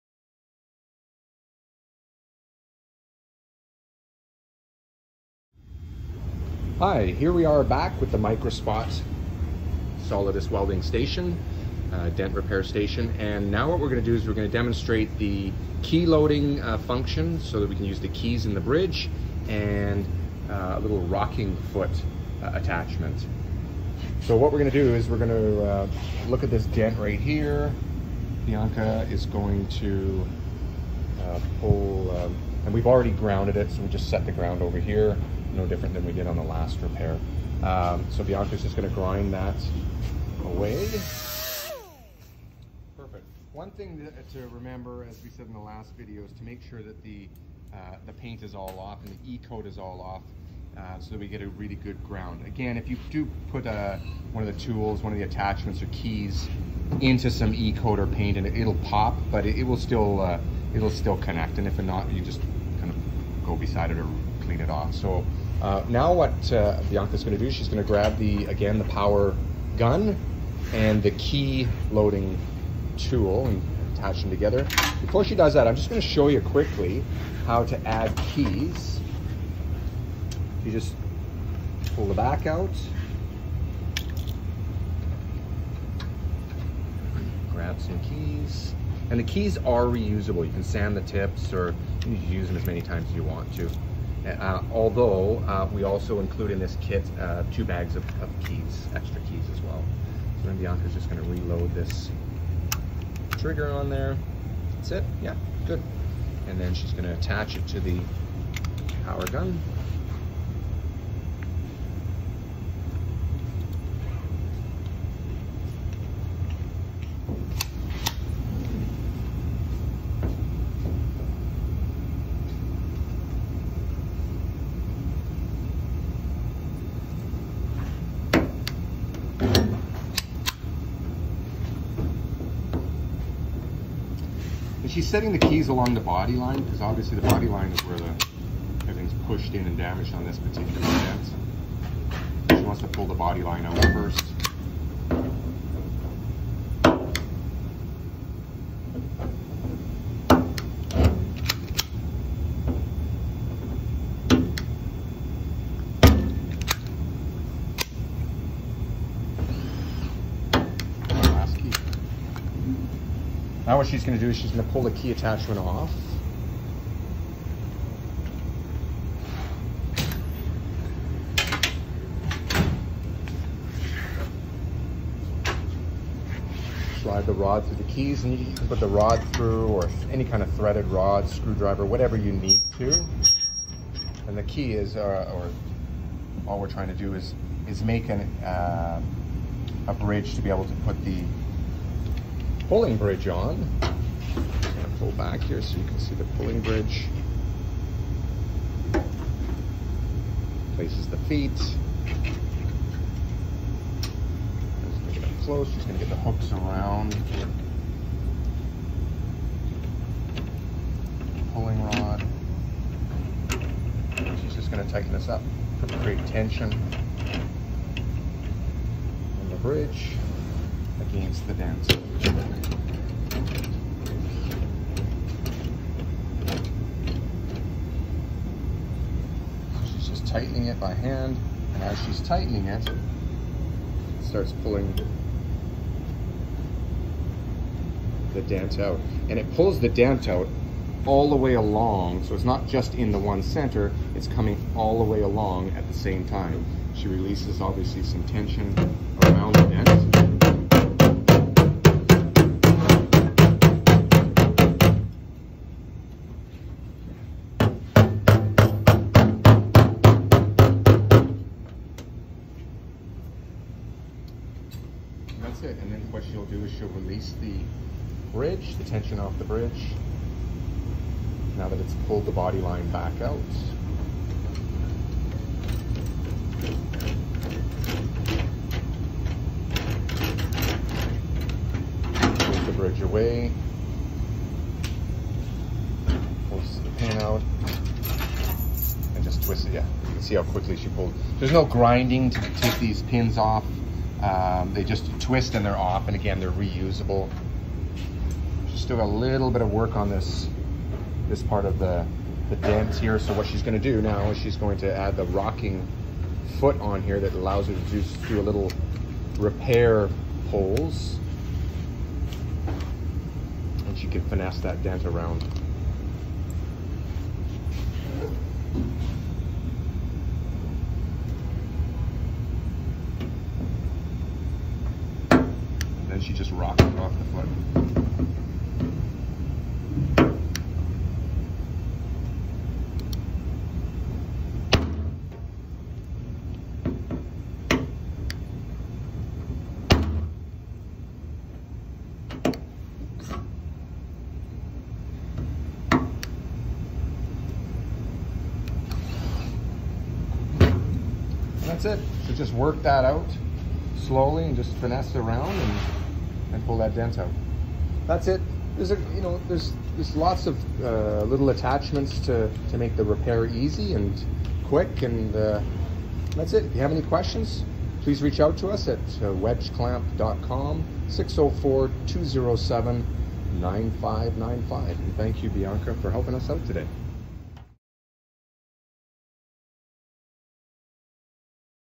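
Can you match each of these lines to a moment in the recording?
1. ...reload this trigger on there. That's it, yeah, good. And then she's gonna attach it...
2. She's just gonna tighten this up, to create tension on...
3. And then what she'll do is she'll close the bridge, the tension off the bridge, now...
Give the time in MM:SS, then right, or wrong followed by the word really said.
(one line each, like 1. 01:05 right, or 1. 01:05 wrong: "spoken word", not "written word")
1. 01:41 right
2. 03:34 right
3. 04:25 wrong: "release", not "close".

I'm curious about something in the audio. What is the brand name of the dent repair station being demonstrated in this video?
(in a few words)
Microspot Solidus.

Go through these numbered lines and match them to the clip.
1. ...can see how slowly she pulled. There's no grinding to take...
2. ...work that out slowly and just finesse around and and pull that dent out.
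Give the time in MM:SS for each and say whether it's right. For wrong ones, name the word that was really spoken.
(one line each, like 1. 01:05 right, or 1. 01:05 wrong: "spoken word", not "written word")
1. 04:50 wrong: "quickly", not "slowly"
2. 05:52 right.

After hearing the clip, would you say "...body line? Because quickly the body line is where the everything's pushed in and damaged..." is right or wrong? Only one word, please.
wrong.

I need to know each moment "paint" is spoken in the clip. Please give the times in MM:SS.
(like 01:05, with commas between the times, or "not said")
00:48, 00:58.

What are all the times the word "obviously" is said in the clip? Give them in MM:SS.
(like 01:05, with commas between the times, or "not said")
02:16, 04:07.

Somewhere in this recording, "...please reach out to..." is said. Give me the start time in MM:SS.
06:08.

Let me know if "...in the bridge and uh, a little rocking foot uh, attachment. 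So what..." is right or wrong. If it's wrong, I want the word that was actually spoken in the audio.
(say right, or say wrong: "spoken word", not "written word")
right.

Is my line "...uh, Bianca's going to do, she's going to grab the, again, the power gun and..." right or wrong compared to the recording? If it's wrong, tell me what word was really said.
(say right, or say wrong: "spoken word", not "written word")
right.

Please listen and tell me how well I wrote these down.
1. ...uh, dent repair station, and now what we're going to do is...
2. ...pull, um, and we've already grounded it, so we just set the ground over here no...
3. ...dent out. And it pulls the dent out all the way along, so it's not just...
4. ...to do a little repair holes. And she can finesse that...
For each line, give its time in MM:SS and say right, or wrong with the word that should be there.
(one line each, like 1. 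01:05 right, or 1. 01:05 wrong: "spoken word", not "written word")
1. 00:11 right
2. 00:31 right
3. 03:58 right
4. 05:07 right.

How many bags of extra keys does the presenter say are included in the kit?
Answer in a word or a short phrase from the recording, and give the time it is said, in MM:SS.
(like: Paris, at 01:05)
2, at 01:37.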